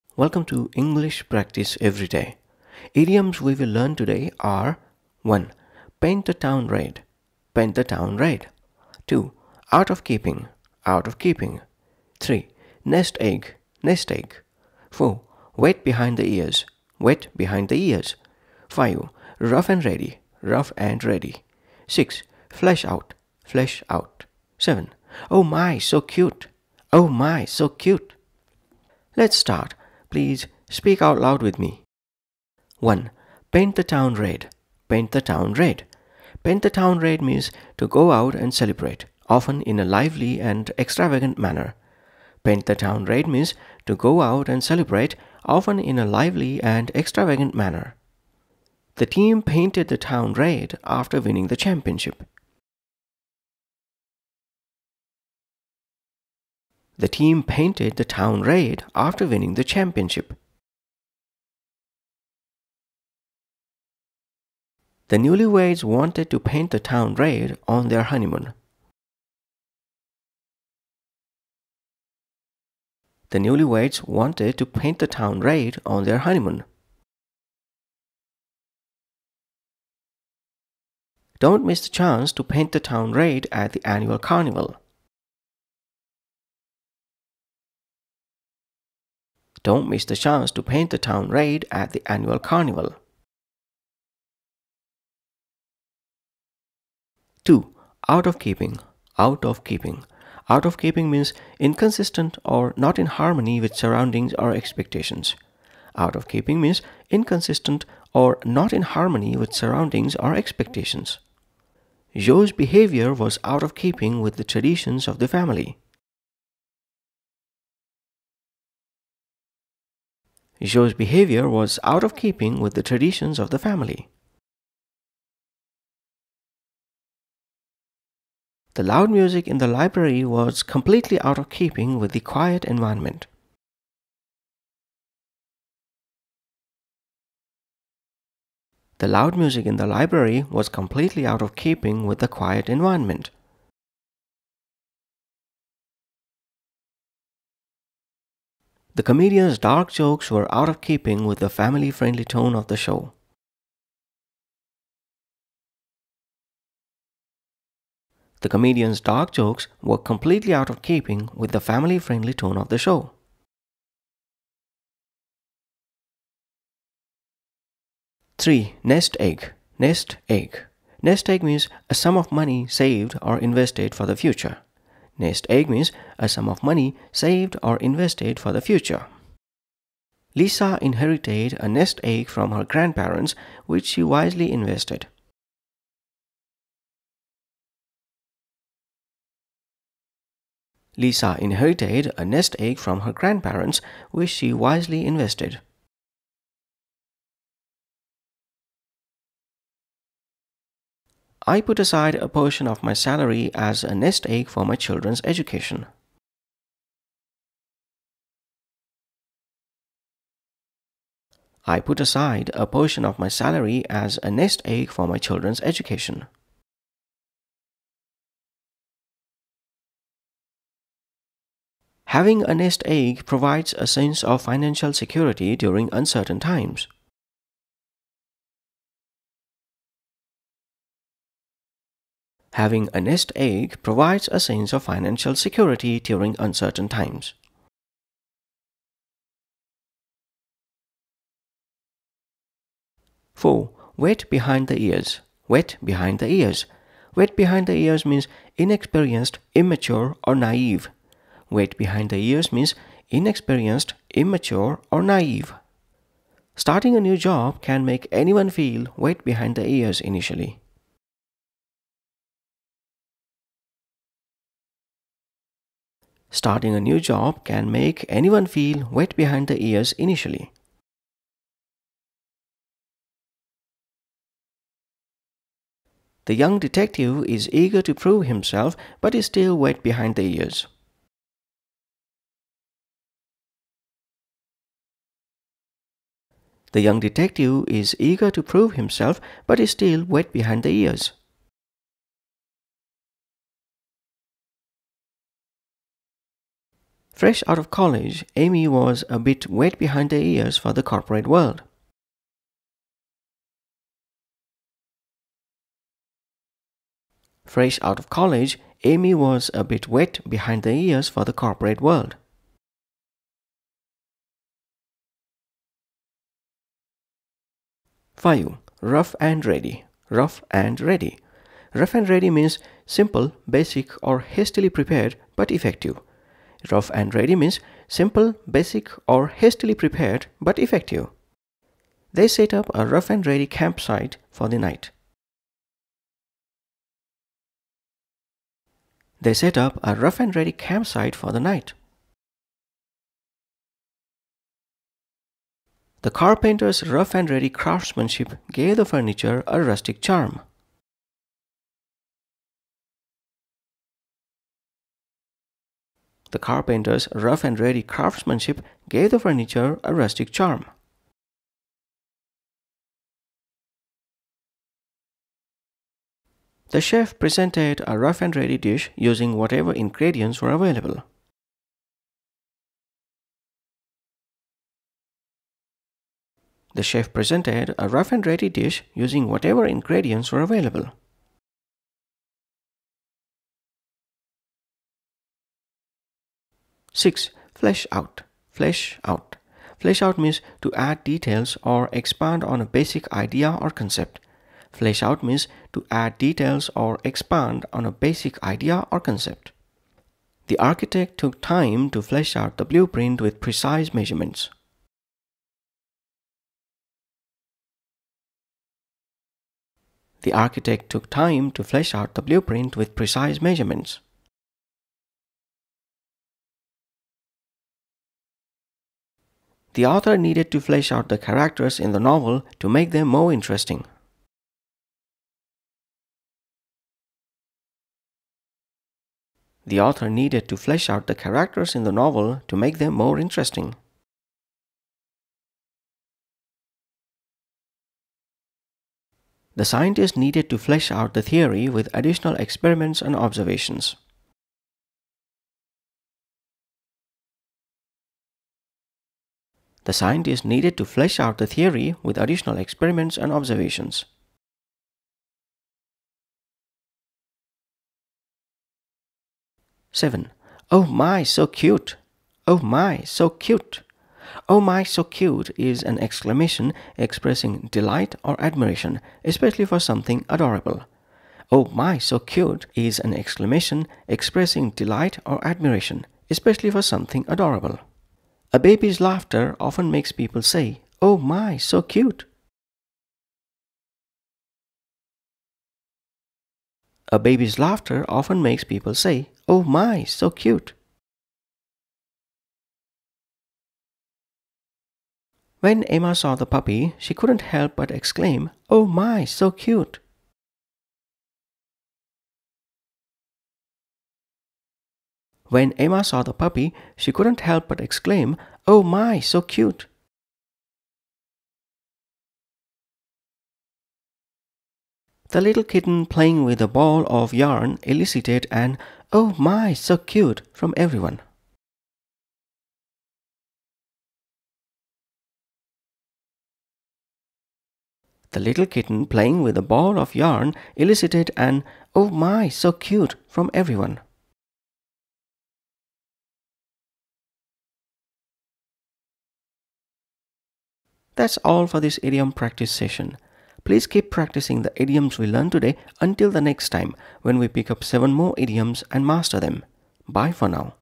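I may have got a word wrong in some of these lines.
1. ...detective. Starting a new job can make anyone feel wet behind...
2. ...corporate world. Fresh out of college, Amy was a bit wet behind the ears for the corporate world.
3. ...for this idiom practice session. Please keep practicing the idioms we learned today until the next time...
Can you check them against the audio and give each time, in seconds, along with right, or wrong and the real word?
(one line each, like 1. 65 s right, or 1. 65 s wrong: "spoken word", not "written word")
1. 255 s wrong: "naive", not "detective"
2. 300 s right
3. 541 s right.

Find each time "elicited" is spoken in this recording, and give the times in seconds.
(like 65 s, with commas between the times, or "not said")
517 s, 530 s.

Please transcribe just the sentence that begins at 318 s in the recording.
Fayu, rough and ready, rough and ready.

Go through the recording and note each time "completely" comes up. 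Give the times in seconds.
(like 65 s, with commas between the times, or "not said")
130 s, 140 s, 159 s.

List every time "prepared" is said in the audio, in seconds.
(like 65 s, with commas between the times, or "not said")
324 s, 329 s.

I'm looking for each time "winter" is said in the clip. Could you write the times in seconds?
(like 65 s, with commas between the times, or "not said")
not said.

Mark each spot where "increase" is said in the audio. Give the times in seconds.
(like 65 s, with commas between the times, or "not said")
not said.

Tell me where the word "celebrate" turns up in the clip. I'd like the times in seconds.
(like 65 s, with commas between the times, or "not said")
38 s, 44 s.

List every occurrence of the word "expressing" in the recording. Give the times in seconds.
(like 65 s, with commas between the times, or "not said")
466 s, 474 s.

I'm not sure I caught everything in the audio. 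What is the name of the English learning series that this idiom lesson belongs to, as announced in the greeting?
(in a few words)
English Practice Every Day.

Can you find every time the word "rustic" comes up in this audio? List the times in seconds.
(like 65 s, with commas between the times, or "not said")
349 s, 359 s.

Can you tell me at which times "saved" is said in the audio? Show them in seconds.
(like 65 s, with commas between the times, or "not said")
172 s, 177 s.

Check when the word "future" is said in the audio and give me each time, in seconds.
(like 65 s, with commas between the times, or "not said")
174 s, 178 s.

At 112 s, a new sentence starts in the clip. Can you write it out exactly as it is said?
Joe's behavior was out of keeping with the traditions of the family.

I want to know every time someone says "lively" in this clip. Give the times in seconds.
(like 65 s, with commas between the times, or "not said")
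39 s, 46 s.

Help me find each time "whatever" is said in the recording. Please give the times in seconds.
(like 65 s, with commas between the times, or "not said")
369 s, 379 s.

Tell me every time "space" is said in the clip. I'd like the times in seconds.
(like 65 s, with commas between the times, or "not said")
not said.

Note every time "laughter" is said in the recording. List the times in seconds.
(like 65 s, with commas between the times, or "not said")
478 s, 487 s.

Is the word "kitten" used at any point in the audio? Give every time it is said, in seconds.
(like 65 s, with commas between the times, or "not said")
515 s, 528 s.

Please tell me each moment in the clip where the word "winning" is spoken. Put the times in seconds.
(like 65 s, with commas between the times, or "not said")
51 s, 59 s.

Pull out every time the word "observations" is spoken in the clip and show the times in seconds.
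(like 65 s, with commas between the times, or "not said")
443 s, 453 s.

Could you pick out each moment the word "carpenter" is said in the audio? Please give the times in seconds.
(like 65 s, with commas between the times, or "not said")
346 s, 356 s.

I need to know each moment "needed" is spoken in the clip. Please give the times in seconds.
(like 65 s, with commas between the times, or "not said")
420 s, 430 s, 440 s, 450 s.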